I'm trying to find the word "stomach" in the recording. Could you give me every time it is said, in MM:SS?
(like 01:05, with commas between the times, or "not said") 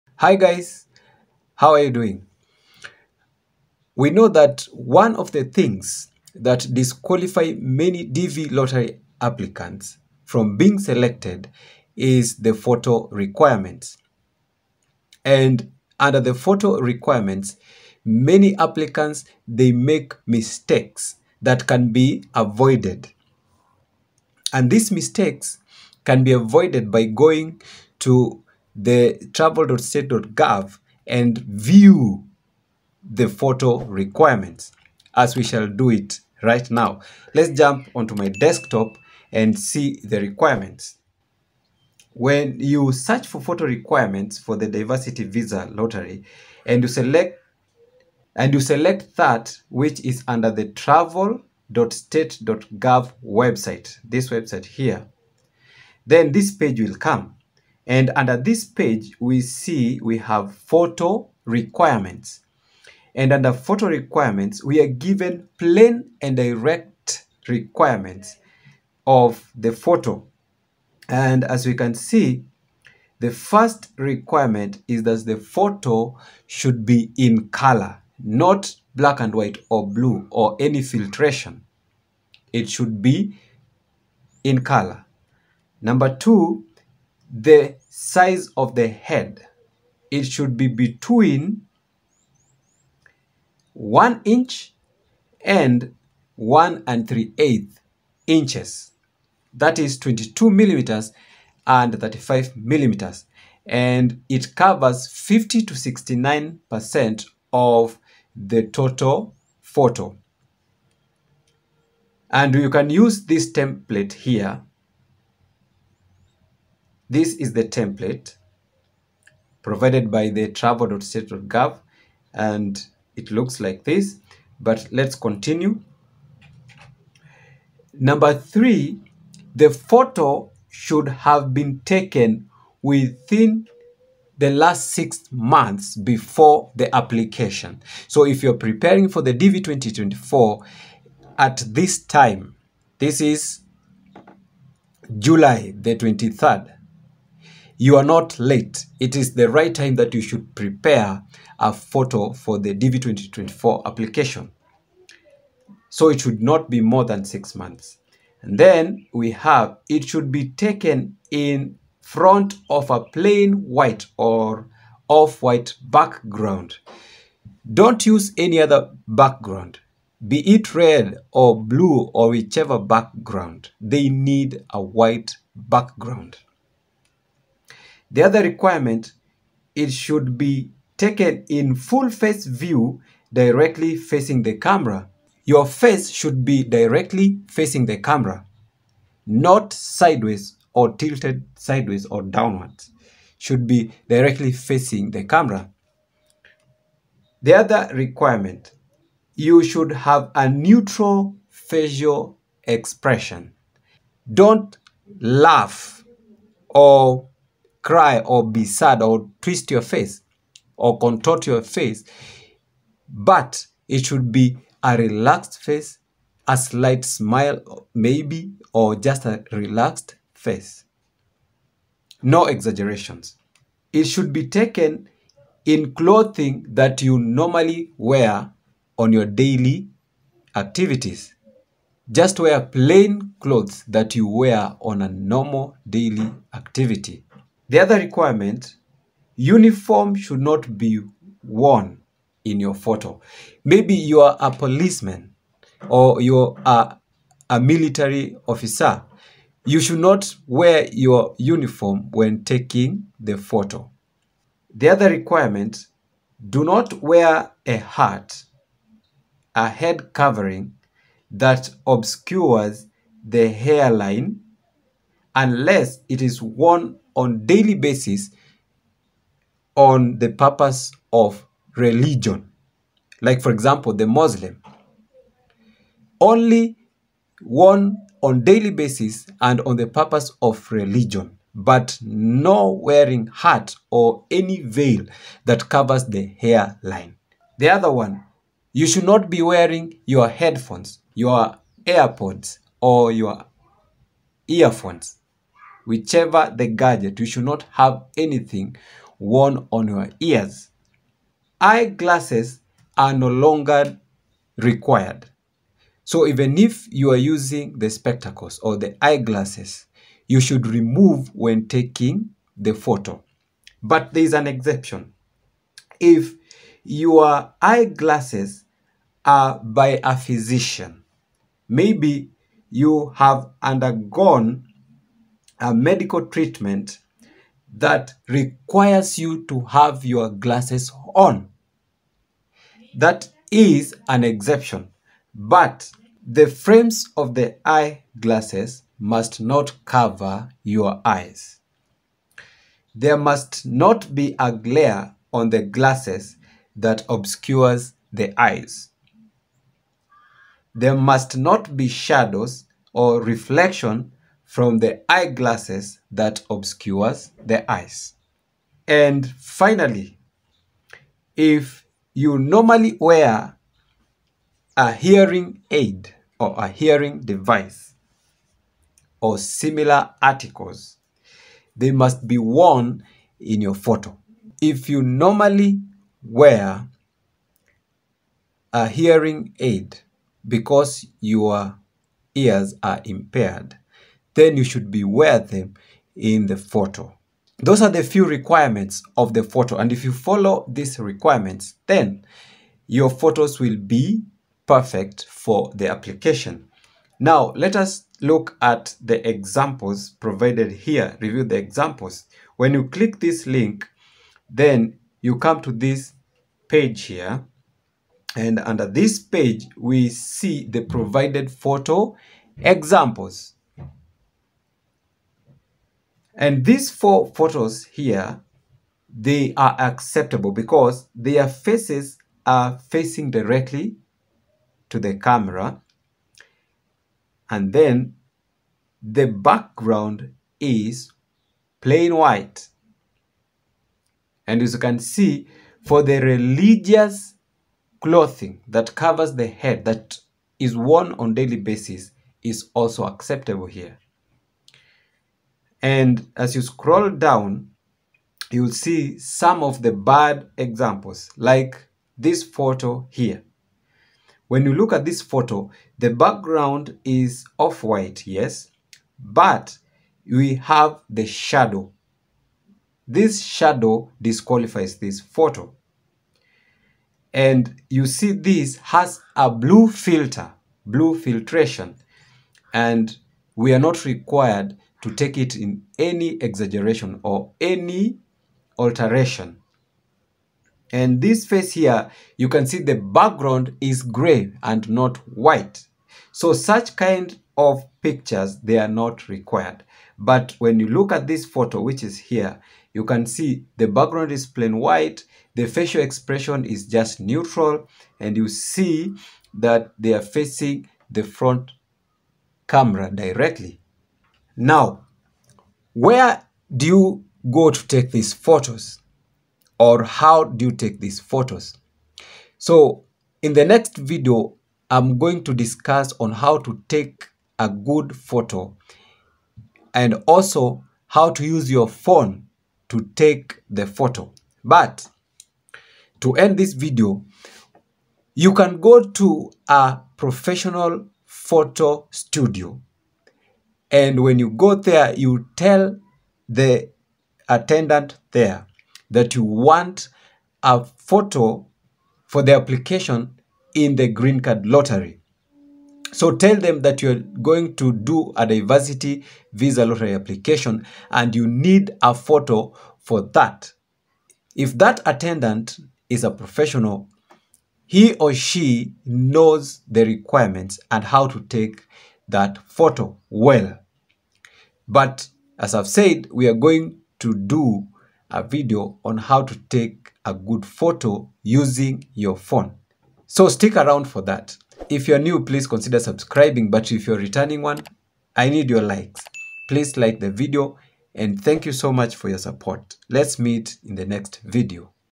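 not said.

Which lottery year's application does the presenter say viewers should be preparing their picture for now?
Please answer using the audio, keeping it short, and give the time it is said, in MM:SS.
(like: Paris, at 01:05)
DV 2024, at 02:19.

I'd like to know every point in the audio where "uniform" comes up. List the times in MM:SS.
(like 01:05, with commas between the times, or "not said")
03:59, 04:11.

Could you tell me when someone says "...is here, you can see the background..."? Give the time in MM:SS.
08:12.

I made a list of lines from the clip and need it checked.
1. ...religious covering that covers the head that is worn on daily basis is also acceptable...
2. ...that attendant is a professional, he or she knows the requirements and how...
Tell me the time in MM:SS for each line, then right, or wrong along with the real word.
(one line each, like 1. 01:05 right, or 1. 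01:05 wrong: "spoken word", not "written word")
1. 07:16 wrong: "clothing", not "covering"
2. 09:14 right.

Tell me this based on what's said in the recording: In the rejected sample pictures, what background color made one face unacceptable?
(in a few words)
gray.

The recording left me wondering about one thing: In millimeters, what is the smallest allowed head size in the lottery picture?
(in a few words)
22 millimeters.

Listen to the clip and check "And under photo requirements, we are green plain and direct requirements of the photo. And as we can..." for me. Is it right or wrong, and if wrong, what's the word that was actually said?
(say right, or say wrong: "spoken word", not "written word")
wrong: "given", not "green".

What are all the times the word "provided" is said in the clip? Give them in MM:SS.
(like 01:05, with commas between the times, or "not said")
01:59, 06:40, 06:50.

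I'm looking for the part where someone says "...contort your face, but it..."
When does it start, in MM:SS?
03:30.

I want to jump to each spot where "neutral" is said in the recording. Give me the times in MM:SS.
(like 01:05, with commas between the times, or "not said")
03:20, 08:17.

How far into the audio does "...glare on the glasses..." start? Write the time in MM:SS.
05:44.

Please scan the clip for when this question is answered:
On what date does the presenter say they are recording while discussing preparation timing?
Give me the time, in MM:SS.
02:25.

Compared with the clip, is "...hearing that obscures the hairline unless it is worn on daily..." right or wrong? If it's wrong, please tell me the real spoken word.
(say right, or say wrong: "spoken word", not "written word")
wrong: "covering", not "hearing".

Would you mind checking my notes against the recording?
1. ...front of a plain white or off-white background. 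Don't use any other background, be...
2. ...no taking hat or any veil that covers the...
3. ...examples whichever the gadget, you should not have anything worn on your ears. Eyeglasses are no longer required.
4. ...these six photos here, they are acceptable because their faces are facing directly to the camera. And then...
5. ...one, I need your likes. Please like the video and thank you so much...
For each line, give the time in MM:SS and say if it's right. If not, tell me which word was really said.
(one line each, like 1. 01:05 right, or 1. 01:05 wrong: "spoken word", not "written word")
1. 02:42 right
2. 04:42 wrong: "wearing", not "taking"
3. 04:54 wrong: "earphones", not "examples"
4. 06:56 wrong: "four", not "six"
5. 09:37 right.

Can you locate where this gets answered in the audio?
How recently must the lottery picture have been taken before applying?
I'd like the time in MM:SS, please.
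02:12.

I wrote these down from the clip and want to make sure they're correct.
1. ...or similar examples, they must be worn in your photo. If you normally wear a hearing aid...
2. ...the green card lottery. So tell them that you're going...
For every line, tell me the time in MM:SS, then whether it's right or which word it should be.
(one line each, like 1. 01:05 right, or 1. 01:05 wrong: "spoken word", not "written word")
1. 06:09 wrong: "articles", not "examples"
2. 09:03 right.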